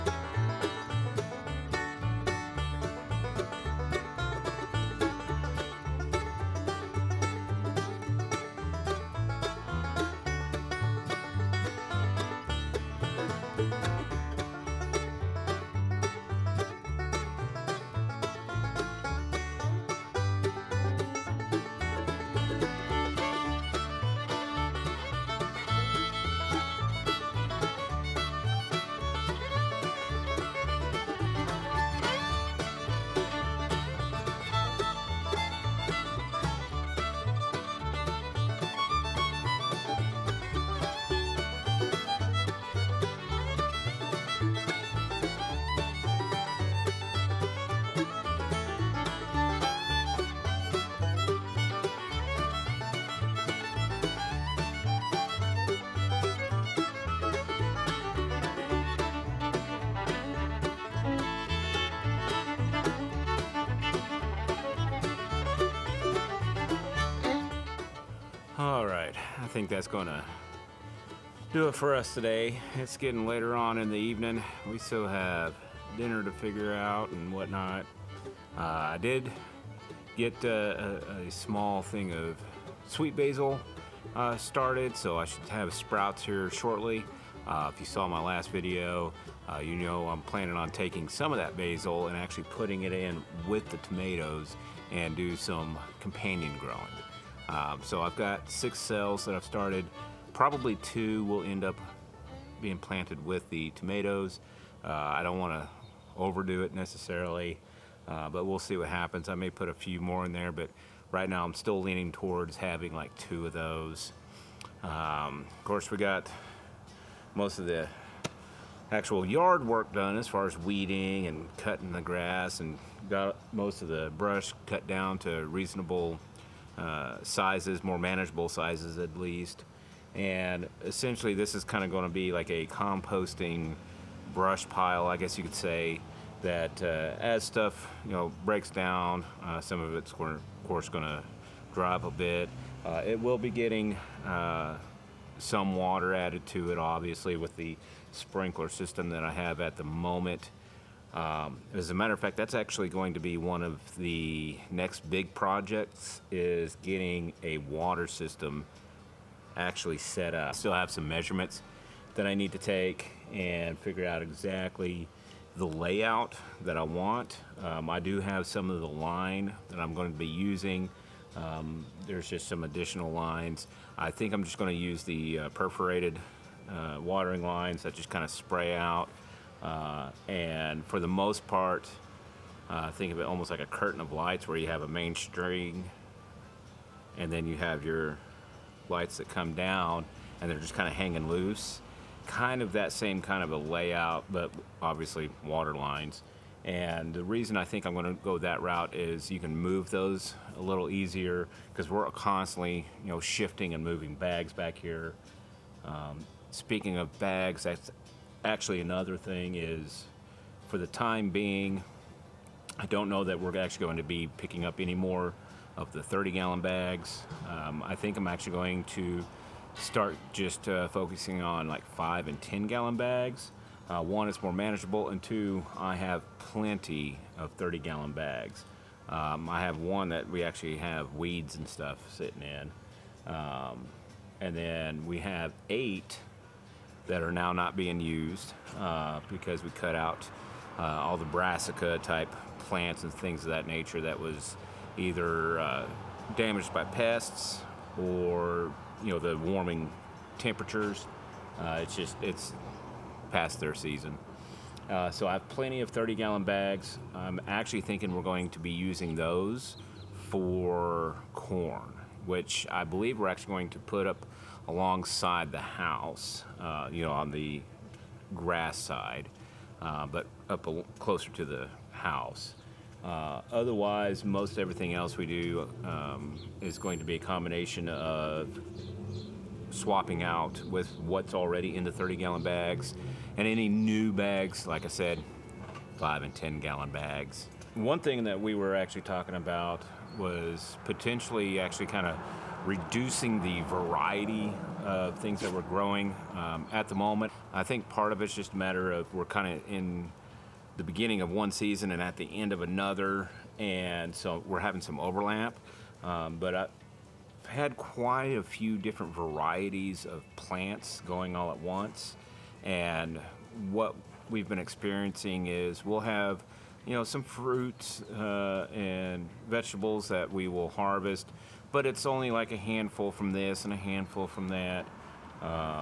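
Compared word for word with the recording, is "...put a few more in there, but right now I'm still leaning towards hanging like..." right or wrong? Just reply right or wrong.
wrong.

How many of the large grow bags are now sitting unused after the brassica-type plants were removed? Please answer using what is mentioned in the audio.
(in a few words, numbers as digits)
8.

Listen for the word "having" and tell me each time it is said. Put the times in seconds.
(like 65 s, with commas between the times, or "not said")
112 s, 304 s.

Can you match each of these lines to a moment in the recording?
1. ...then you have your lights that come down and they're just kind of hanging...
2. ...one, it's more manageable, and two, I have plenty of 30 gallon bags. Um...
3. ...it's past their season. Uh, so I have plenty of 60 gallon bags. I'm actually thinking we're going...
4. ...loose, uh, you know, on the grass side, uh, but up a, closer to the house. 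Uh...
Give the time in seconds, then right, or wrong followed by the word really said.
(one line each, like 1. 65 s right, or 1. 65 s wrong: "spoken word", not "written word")
1. 187 s right
2. 224 s right
3. 252 s wrong: "30", not "60"
4. 265 s wrong: "house", not "loose".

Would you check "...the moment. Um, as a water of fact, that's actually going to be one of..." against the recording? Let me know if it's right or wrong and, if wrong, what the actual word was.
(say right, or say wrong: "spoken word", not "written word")
wrong: "matter", not "water".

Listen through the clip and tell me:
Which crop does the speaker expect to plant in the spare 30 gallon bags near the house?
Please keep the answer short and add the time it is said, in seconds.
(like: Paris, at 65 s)
corn, at 261 s.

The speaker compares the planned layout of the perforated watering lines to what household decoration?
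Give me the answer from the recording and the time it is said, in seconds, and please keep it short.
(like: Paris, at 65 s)
a curtain of lights, at 183 s.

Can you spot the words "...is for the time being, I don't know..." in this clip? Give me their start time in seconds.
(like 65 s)
209 s.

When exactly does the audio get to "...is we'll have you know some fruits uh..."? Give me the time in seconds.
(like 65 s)
315 s.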